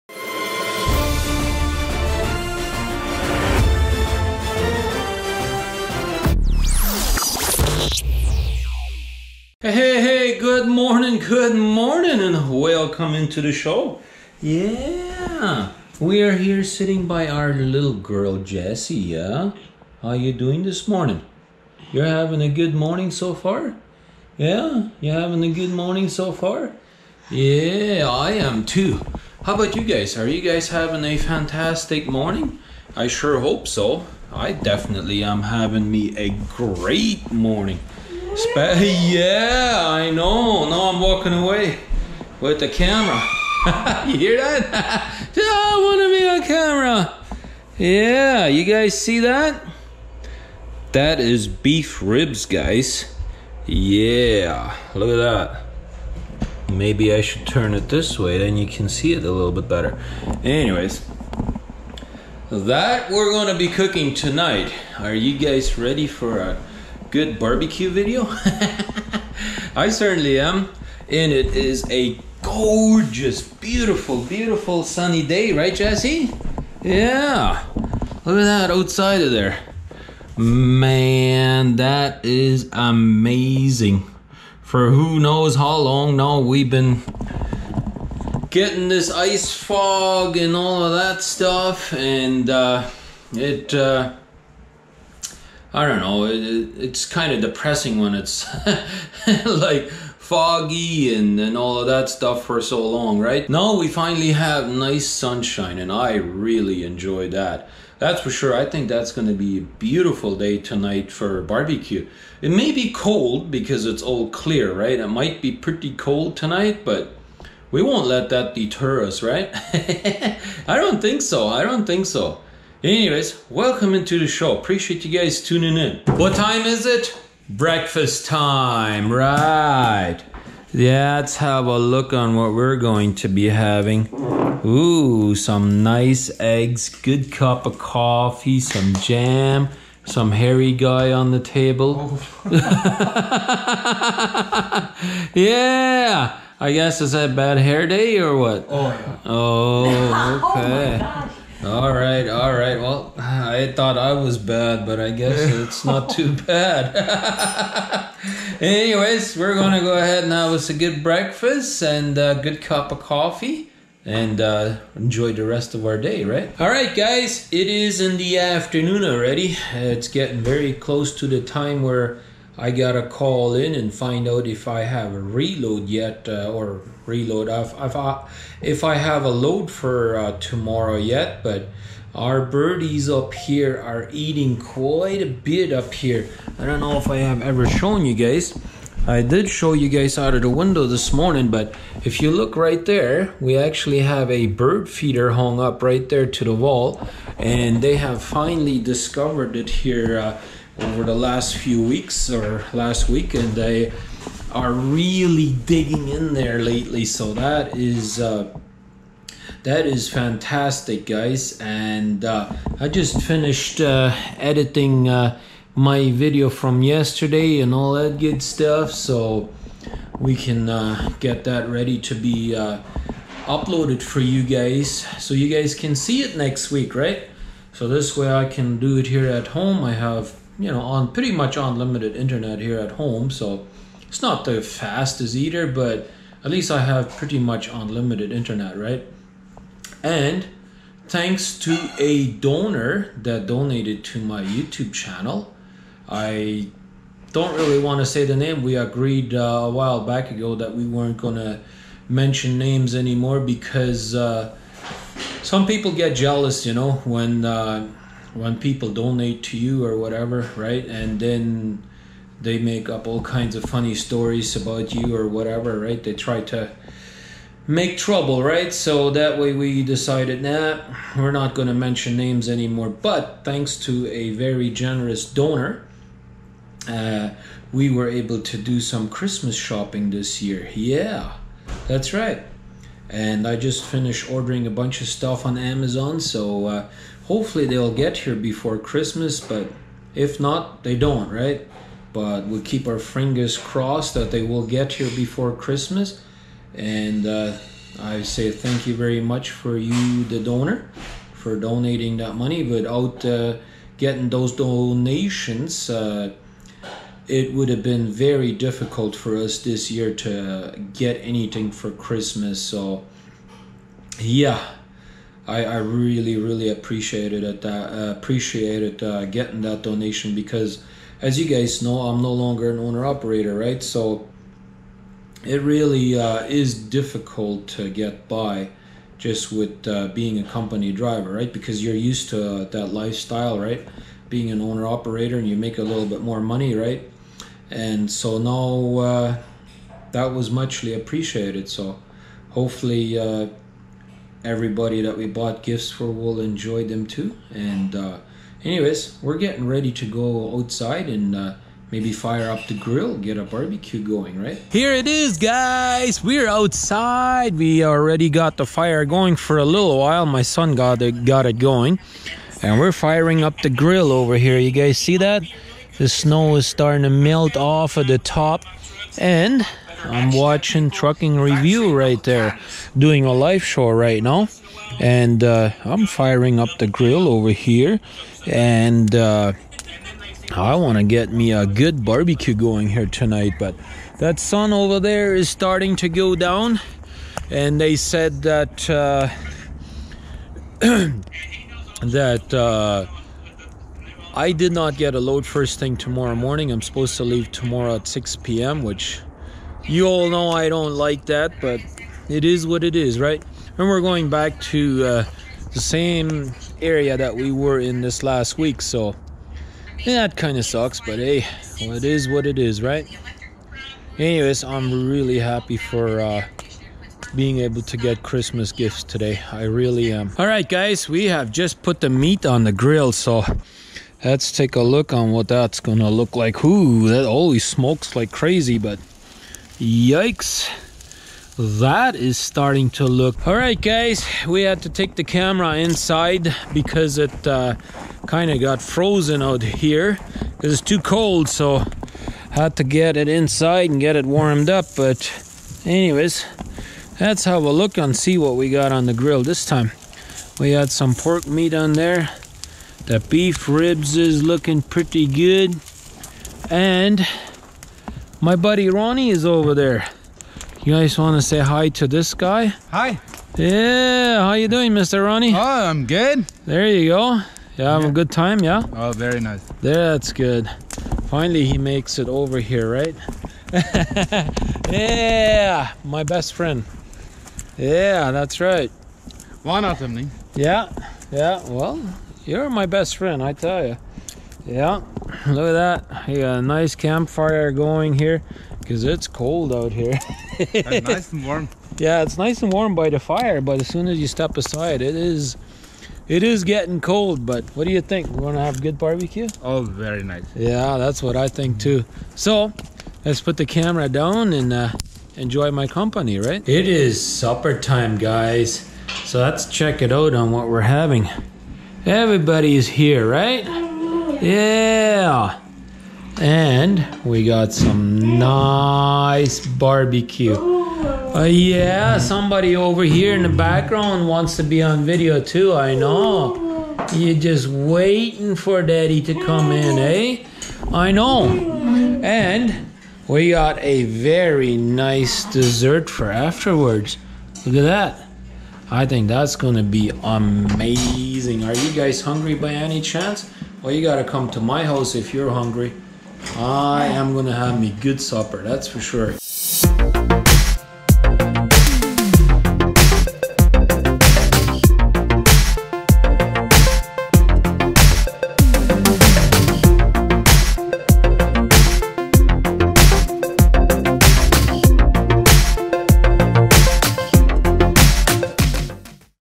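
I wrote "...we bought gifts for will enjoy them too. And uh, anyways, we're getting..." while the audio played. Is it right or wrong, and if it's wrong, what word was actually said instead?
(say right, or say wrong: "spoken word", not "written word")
right.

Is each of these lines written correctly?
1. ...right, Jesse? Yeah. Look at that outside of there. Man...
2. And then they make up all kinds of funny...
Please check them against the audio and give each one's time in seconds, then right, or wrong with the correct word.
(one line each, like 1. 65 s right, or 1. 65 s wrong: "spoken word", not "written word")
1. 75 s right
2. 260 s right.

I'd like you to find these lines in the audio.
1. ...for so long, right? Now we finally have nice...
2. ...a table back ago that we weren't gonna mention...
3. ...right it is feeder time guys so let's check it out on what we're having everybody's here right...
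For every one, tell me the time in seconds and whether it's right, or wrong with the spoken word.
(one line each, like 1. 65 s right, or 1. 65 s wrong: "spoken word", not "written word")
1. 102 s right
2. 249 s wrong: "while", not "table"
3. 506 s wrong: "supper", not "feeder".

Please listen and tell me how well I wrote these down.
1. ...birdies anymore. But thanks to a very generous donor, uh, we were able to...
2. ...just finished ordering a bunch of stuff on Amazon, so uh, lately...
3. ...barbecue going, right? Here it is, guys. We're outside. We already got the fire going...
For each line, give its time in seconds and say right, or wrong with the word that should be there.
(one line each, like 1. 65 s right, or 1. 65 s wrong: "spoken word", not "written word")
1. 272 s wrong: "names", not "birdies"
2. 283 s wrong: "hopefully", not "lately"
3. 353 s right.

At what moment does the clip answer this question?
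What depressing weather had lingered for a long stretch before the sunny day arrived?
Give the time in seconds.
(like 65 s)
89 s.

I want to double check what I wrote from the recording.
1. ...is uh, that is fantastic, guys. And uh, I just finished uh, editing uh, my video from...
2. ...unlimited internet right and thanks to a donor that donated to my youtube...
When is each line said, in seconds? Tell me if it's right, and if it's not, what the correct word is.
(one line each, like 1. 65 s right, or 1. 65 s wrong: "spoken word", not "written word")
1. 207 s right
2. 237 s right.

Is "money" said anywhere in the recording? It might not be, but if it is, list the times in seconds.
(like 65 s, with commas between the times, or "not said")
302 s, 336 s.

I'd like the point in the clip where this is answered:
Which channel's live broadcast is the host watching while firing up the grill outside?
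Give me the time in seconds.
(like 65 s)
370 s.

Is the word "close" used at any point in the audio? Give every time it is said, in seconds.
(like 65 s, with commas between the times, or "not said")
170 s.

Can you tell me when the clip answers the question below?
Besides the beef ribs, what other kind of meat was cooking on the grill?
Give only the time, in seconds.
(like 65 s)
451 s.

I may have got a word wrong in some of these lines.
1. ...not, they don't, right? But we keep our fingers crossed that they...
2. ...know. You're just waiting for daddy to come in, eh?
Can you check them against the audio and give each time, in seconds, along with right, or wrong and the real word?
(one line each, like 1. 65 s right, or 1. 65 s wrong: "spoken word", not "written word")
1. 290 s right
2. 525 s right.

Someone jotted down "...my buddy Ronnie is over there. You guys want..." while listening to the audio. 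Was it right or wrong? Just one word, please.
right.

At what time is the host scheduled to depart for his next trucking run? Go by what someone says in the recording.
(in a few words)
6 p.m.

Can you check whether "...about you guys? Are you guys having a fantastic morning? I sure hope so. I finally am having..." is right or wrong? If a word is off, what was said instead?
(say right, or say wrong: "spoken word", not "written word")
wrong: "definitely", not "finally".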